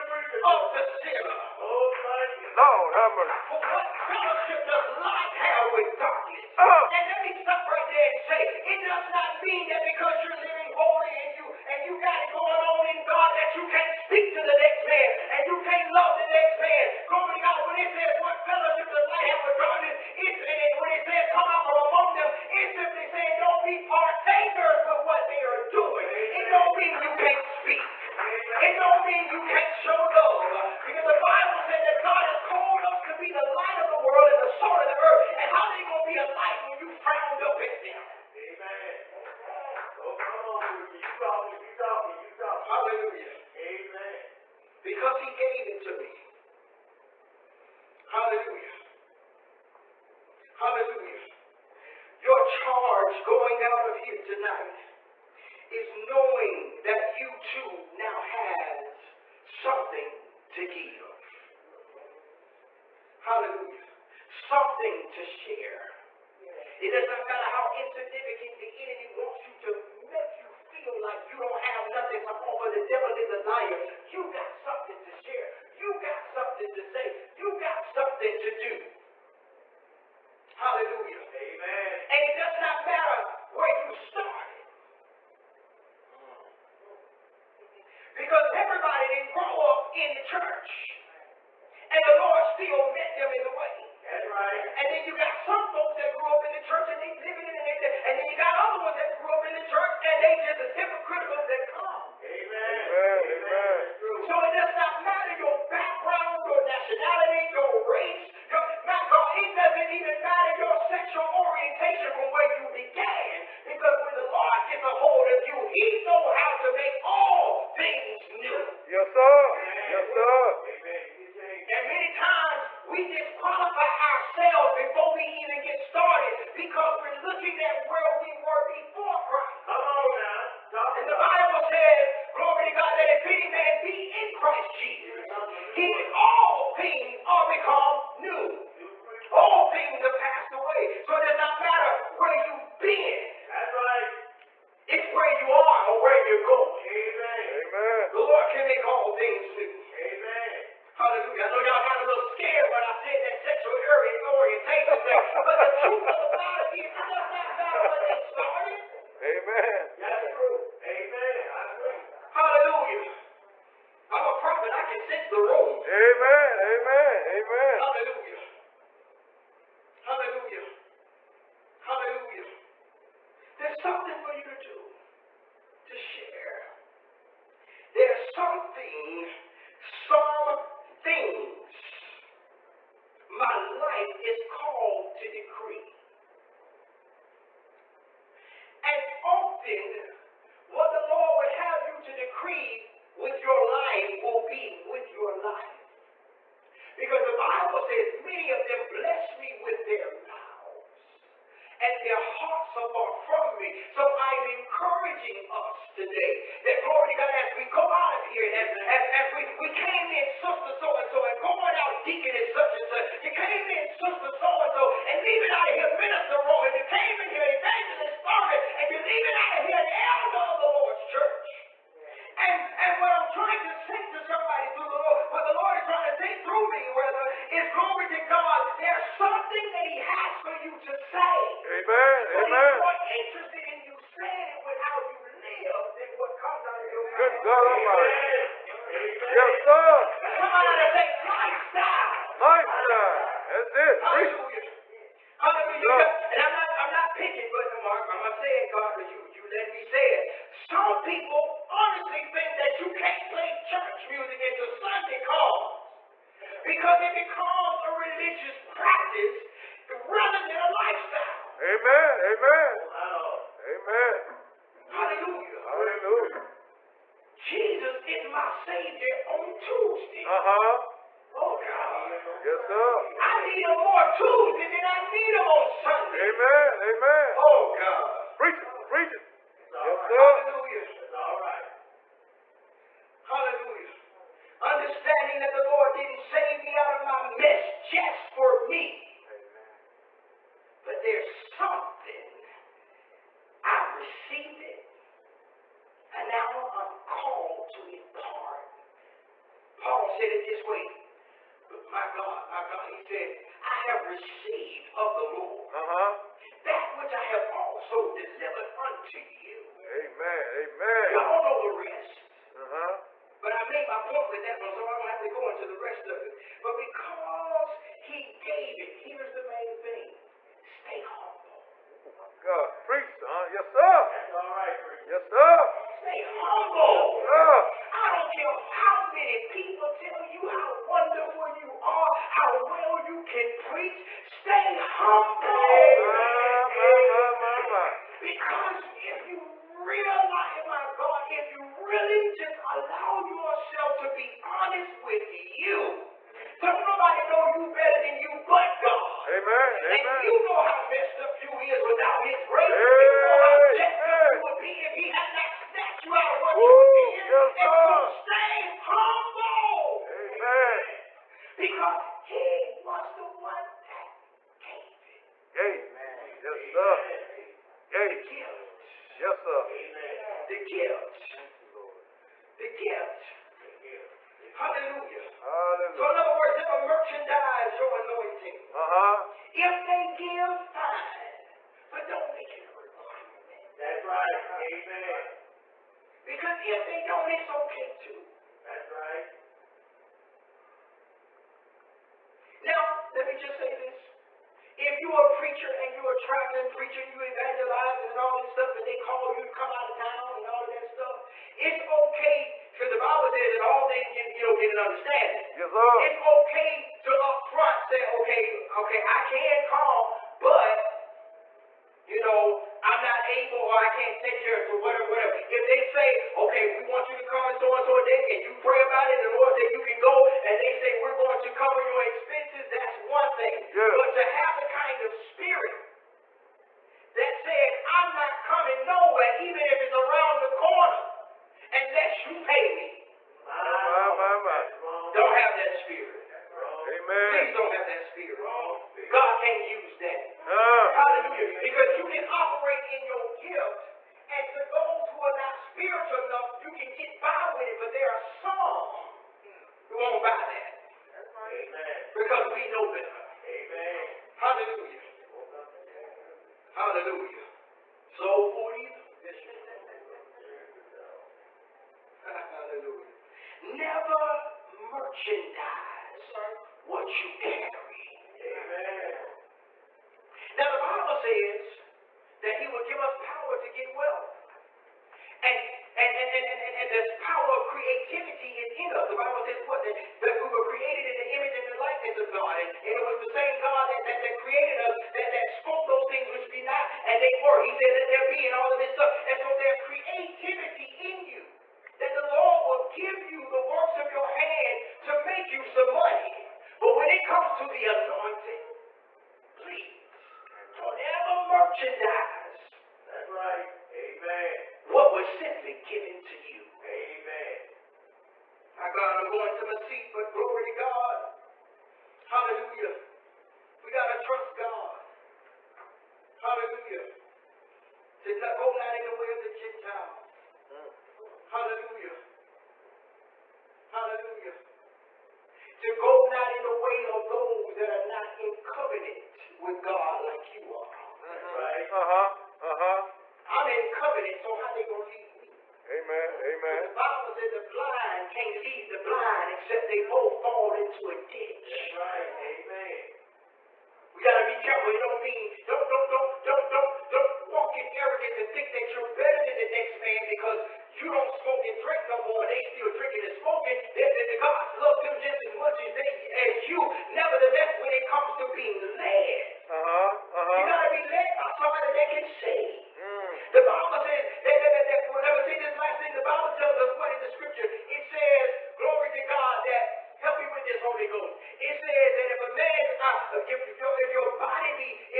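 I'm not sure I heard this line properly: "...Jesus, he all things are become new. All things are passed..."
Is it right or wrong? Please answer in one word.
right.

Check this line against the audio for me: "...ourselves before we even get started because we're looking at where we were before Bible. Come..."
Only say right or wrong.
wrong.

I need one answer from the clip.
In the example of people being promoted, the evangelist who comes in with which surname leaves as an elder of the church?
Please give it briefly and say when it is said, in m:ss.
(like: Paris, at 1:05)
Thurman, at 3:38.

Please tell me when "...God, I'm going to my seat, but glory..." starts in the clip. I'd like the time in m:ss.
8:28.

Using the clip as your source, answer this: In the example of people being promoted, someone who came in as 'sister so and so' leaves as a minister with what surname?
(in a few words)
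Rowan.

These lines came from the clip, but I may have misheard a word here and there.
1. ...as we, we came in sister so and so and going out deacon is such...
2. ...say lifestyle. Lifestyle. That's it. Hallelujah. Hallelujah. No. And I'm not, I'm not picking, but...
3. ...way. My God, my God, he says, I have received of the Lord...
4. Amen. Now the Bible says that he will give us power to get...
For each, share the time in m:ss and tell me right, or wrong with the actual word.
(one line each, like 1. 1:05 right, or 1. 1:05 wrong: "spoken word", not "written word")
1. 3:29 right
2. 4:00 right
3. 5:00 right
4. 7:48 right.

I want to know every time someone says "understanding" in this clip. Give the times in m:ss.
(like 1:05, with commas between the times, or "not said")
4:44, 6:44.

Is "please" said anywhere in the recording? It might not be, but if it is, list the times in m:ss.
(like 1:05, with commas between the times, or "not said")
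7:17, 8:19.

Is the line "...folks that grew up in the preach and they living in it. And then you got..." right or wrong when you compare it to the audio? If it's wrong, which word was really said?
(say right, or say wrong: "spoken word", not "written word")
wrong: "church", not "preach".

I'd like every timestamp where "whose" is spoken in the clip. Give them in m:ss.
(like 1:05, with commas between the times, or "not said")
not said.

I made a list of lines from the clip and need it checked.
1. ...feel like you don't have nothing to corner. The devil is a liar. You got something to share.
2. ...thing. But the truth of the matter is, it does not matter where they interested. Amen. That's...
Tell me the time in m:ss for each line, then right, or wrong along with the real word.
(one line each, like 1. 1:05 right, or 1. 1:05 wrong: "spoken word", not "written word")
1. 1:10 wrong: "offer", not "corner"
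2. 2:35 wrong: "started", not "interested".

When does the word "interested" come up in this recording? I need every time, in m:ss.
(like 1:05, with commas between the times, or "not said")
3:53.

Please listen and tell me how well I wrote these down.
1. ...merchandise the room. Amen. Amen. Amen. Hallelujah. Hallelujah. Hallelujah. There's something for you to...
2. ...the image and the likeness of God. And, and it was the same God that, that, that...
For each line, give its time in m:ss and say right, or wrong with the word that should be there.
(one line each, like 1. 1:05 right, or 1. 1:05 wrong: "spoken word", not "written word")
1. 2:44 wrong: "sense", not "merchandise"
2. 8:01 right.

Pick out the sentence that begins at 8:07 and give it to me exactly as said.
He said, let there be, and all of this stuff.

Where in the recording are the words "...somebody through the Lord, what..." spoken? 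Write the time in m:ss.
3:44.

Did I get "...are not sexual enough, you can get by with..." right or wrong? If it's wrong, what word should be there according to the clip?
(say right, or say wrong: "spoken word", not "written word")
wrong: "spiritual", not "sexual".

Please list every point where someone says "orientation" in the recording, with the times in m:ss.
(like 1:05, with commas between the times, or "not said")
1:51, 2:33.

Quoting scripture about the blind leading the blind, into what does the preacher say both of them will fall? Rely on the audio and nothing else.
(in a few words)
A ditch.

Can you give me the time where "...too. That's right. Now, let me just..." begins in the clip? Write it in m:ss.
6:27.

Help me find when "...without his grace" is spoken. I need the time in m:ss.
5:51.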